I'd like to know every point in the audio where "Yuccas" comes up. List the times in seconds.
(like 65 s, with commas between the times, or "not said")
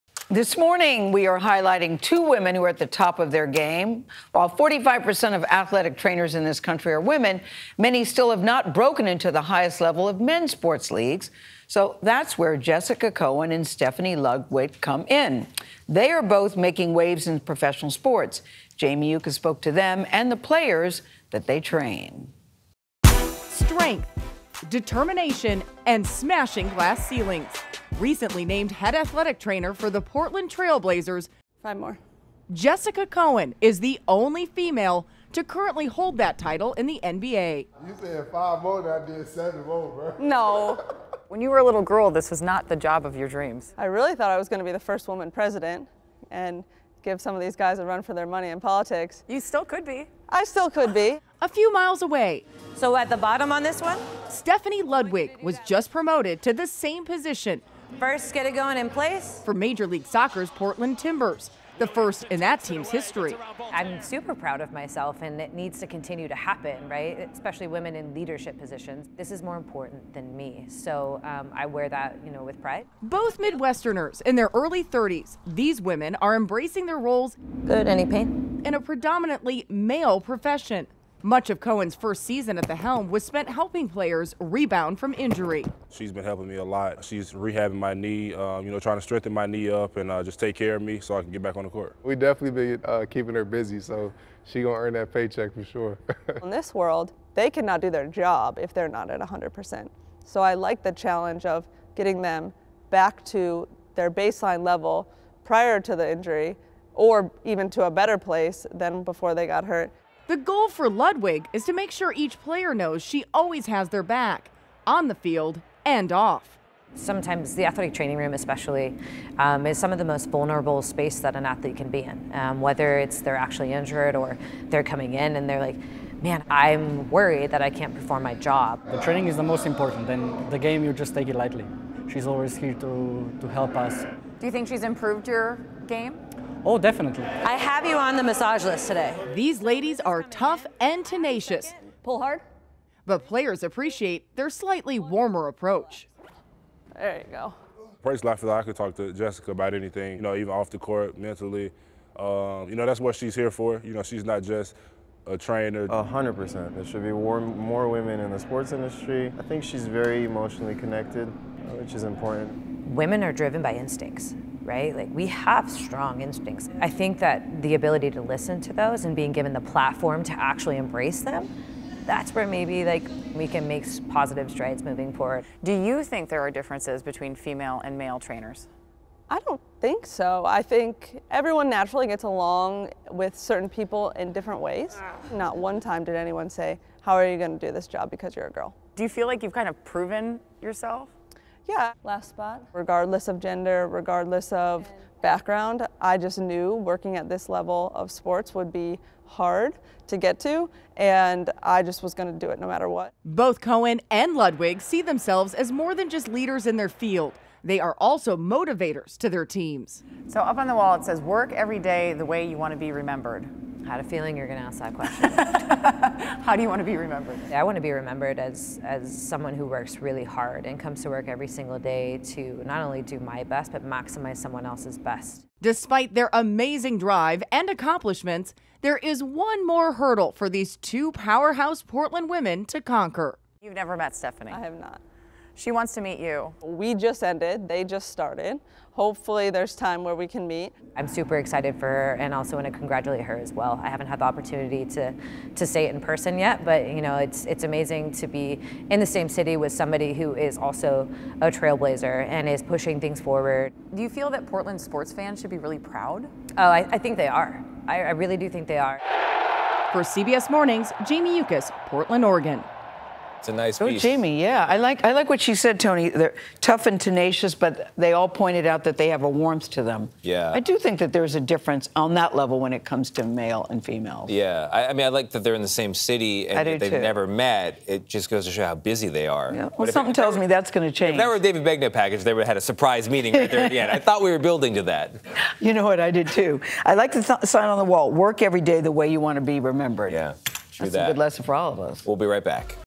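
19 s, 261 s.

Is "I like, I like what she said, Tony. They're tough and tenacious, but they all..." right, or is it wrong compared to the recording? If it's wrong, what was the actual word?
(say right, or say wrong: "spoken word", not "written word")
right.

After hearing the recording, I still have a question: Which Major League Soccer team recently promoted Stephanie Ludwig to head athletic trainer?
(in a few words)
Portland Timbers.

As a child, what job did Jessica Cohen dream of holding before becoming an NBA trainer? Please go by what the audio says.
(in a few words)
First woman president.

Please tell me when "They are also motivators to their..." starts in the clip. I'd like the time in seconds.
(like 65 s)
207 s.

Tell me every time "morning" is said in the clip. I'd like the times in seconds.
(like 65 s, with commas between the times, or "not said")
0 s, 260 s.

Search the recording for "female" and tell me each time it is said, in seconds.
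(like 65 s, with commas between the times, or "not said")
34 s, 177 s, 273 s.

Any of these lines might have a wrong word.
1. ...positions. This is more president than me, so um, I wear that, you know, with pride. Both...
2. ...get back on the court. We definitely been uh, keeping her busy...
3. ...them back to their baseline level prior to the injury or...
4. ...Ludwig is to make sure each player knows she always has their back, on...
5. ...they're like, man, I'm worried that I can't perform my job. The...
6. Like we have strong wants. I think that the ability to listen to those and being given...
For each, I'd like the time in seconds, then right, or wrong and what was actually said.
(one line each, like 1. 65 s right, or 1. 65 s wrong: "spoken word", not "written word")
1. 68 s wrong: "important", not "president"
2. 91 s right
3. 102 s right
4. 110 s right
5. 125 s right
6. 164 s wrong: "instincts", not "wants".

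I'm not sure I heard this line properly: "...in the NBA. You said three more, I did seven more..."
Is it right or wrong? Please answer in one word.
wrong.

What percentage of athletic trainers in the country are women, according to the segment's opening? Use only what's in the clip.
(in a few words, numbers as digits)
45%.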